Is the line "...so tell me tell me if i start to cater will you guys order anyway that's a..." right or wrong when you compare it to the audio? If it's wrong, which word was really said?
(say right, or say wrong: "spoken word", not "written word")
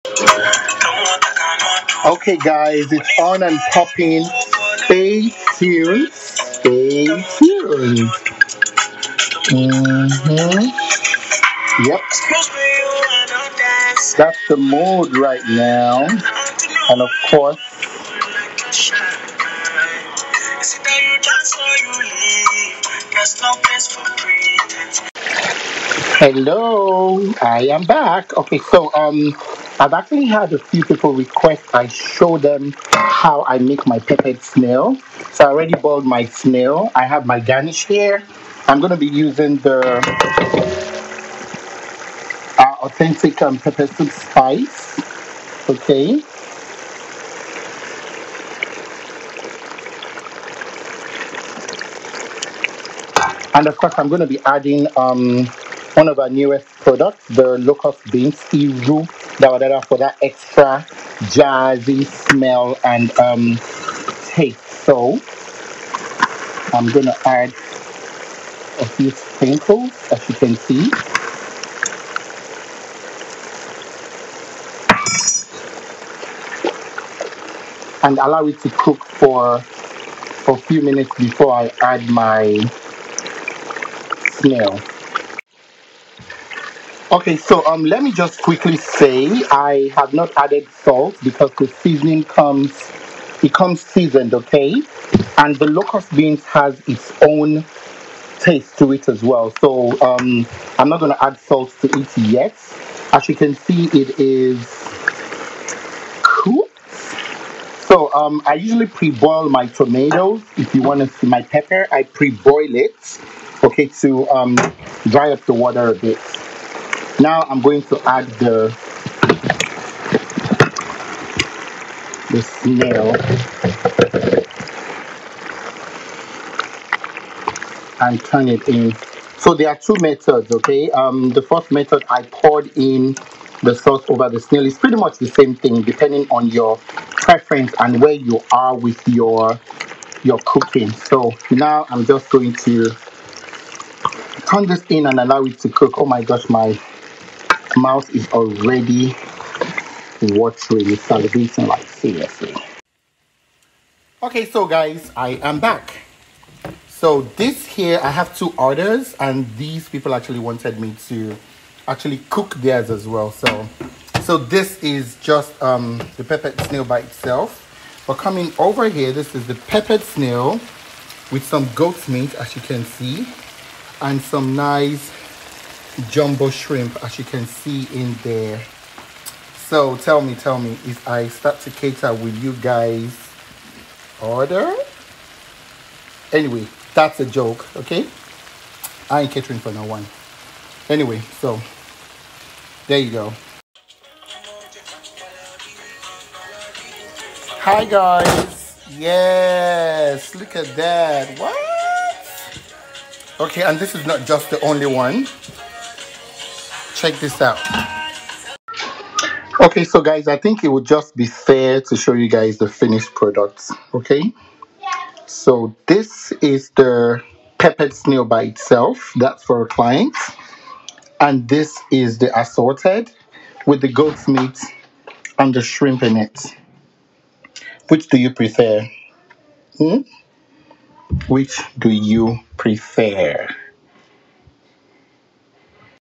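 right.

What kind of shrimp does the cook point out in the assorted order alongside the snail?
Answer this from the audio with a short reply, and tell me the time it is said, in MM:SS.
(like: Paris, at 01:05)
Jumbo shrimp, at 02:56.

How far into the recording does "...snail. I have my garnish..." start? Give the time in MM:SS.
00:36.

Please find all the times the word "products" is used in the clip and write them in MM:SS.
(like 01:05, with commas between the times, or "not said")
00:56, 03:33.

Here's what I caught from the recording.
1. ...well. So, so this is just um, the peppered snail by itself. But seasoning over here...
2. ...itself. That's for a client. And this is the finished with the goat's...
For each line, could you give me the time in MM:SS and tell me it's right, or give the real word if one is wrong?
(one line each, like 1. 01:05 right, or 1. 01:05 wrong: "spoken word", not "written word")
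1. 02:43 wrong: "coming", not "seasoning"
2. 03:38 wrong: "assorted", not "finished".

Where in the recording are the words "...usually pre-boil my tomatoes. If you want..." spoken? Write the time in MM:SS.
01:48.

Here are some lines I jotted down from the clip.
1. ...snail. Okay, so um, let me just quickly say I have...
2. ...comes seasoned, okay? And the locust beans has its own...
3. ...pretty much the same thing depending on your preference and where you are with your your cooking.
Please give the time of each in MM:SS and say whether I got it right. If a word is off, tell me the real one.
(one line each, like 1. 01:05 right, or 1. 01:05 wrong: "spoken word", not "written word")
1. 01:24 right
2. 01:33 right
3. 02:14 right.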